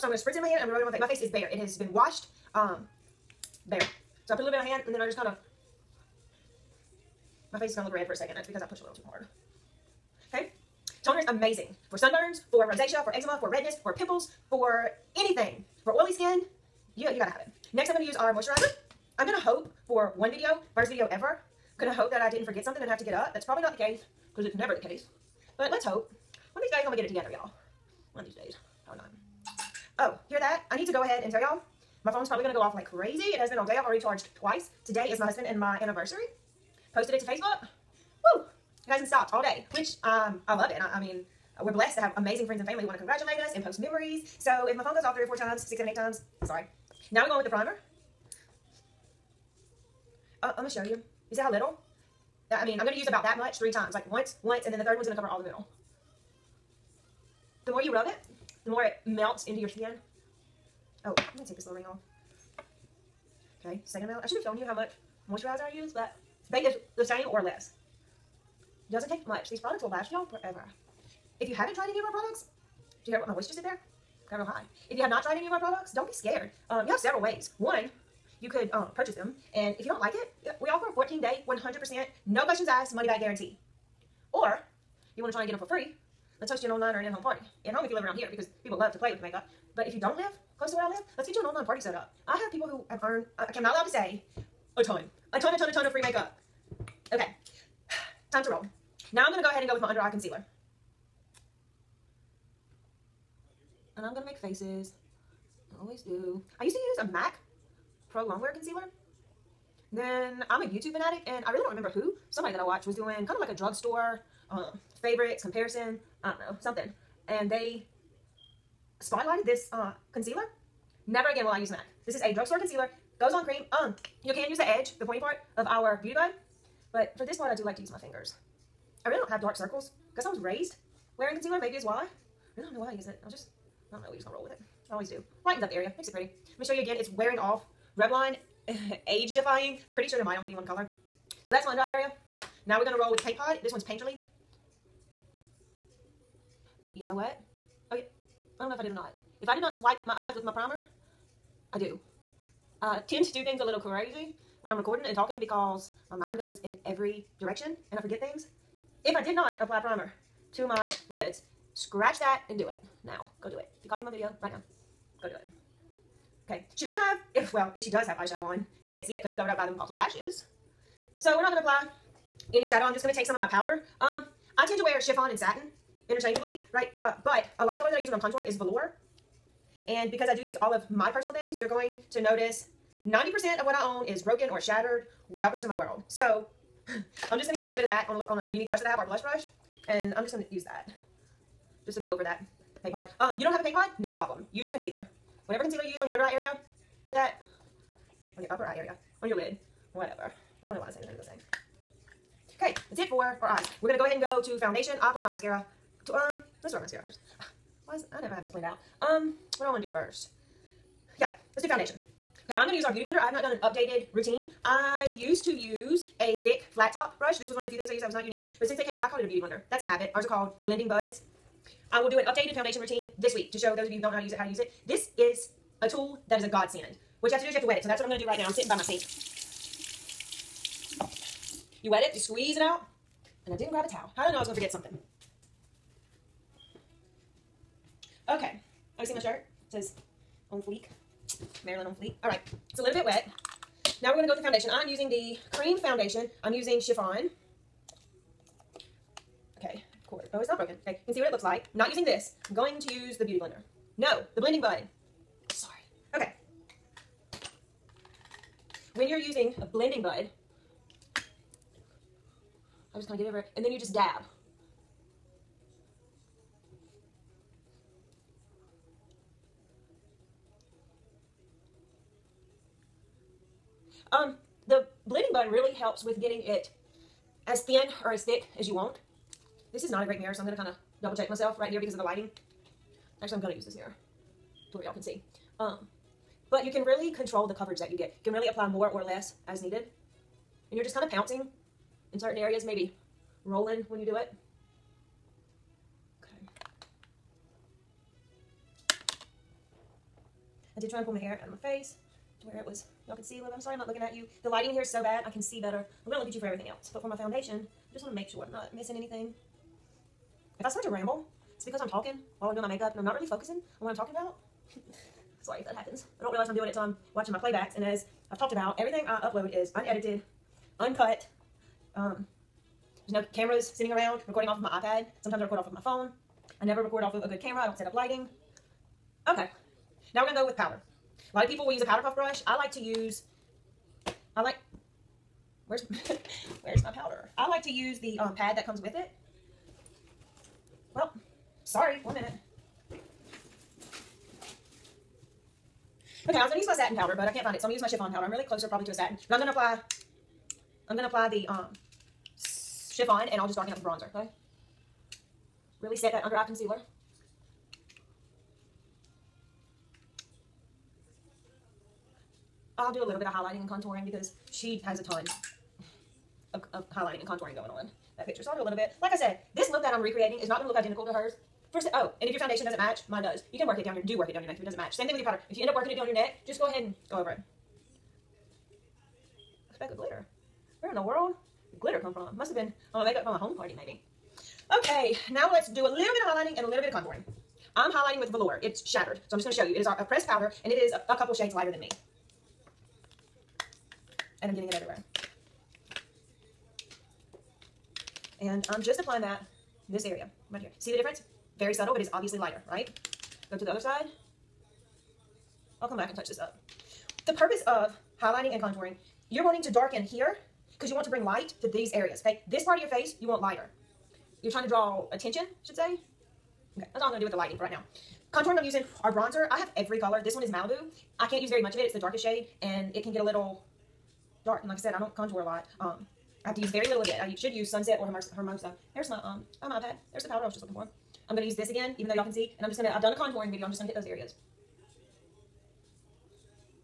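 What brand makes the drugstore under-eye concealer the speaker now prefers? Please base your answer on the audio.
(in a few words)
Revlon.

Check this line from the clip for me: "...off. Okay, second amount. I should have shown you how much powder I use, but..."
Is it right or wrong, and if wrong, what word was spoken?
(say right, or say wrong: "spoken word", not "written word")
wrong: "moisturizer", not "powder".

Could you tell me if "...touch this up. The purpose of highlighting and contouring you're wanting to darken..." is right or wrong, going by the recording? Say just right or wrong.
right.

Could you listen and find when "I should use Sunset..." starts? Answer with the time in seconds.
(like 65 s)
427 s.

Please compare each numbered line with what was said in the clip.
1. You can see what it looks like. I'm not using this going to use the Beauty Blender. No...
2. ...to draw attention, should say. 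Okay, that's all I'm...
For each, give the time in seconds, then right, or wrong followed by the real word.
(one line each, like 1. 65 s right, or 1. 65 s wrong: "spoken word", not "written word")
1. 251 s right
2. 414 s right.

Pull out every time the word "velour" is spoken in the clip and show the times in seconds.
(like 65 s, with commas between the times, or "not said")
178 s, 388 s.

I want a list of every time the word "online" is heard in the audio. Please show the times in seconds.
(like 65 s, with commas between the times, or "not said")
86 s, 91 s.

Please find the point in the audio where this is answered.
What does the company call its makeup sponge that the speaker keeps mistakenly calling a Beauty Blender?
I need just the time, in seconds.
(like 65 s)
220 s.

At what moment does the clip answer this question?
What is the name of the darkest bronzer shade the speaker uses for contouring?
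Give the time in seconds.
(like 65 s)
420 s.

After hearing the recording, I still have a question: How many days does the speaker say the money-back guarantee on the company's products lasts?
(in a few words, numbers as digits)
14.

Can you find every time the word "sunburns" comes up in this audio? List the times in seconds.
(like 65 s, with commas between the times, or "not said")
11 s.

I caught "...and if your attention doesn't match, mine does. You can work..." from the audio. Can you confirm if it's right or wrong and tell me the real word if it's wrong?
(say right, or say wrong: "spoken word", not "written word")
wrong: "foundation", not "attention".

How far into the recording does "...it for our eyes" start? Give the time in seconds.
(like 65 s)
202 s.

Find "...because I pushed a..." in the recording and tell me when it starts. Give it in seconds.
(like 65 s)
8 s.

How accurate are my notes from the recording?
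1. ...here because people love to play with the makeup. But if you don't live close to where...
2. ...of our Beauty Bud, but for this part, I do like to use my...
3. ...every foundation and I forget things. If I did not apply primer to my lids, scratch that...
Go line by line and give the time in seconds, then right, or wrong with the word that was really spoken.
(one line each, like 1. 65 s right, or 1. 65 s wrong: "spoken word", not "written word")
1. 88 s right
2. 125 s right
3. 156 s wrong: "direction", not "foundation".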